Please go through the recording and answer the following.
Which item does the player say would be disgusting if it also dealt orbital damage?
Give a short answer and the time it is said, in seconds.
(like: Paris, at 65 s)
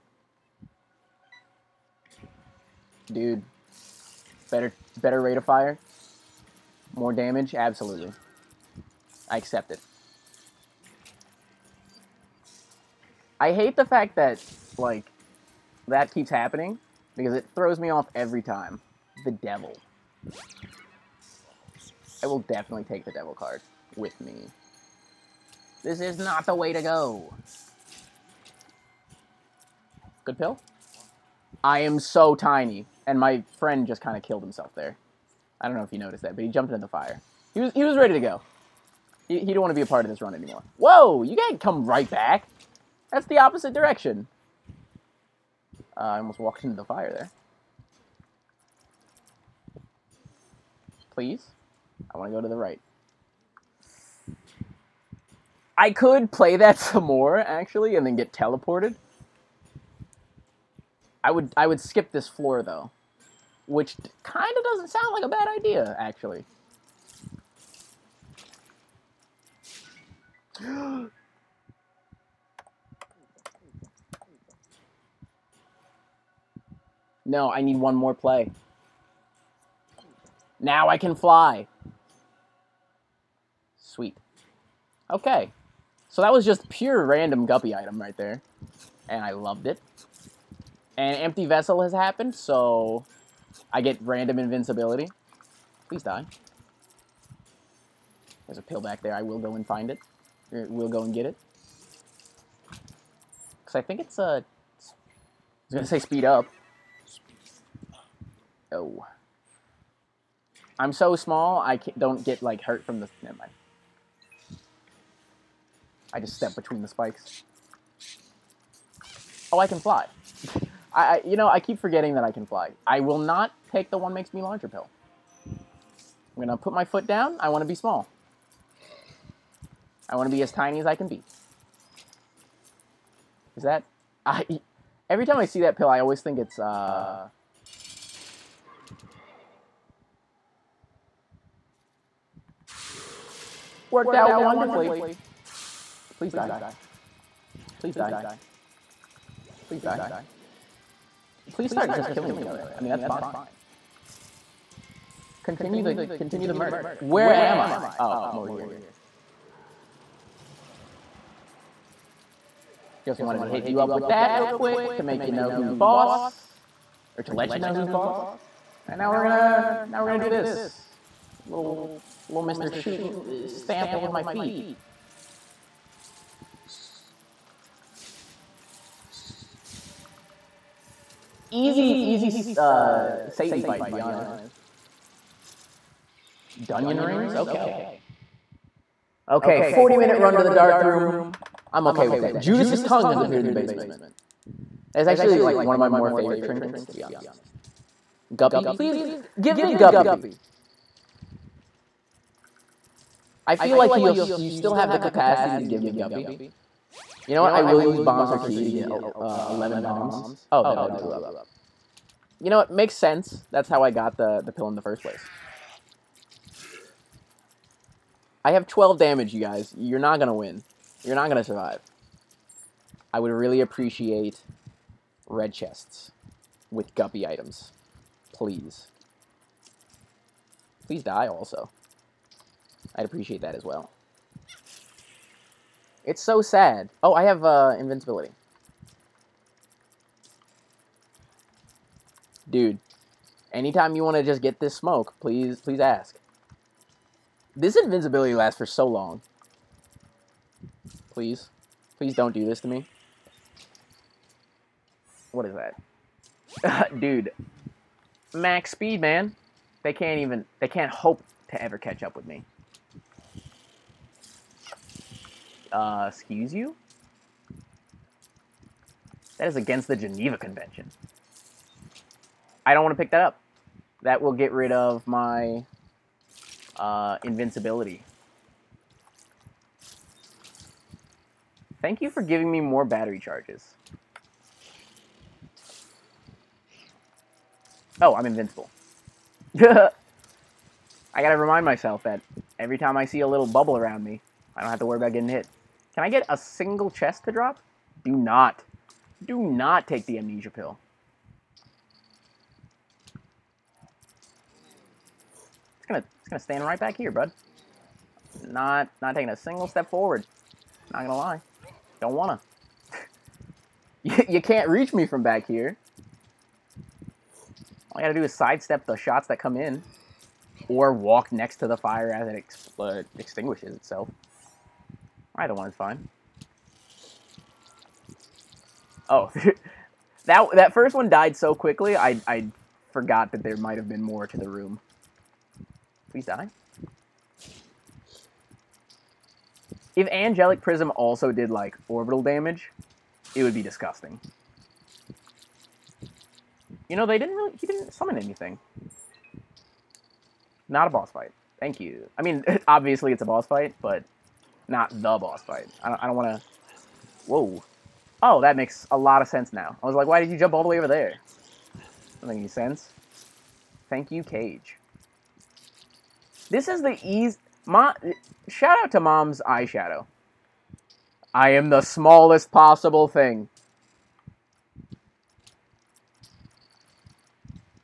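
Angelic Prism, at 340 s.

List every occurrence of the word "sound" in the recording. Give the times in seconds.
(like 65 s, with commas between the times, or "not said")
64 s.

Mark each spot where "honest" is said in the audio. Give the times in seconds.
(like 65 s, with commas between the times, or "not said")
183 s, 197 s.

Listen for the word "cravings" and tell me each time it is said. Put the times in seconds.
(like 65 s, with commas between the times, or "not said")
not said.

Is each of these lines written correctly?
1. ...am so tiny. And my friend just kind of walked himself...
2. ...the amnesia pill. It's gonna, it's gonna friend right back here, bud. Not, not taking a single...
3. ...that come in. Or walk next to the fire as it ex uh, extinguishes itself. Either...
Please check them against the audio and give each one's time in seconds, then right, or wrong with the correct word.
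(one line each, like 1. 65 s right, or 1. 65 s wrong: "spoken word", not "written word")
1. 31 s wrong: "killed", not "walked"
2. 300 s wrong: "stand", not "friend"
3. 319 s right.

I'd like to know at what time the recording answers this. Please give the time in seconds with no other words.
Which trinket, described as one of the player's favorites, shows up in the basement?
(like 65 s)
192 s.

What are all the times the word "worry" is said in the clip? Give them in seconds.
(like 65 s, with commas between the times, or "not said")
294 s.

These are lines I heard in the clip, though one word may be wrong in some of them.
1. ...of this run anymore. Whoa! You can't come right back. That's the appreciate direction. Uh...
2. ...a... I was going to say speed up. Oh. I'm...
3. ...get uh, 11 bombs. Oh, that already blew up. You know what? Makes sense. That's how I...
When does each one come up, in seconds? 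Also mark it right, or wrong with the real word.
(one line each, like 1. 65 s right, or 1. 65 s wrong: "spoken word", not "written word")
1. 40 s wrong: "opposite", not "appreciate"
2. 104 s right
3. 208 s right.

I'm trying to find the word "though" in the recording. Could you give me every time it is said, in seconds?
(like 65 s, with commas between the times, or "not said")
62 s.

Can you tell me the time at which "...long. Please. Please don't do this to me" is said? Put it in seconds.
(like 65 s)
248 s.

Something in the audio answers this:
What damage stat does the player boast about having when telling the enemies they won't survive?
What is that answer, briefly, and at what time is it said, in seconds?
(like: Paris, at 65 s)
12, at 218 s.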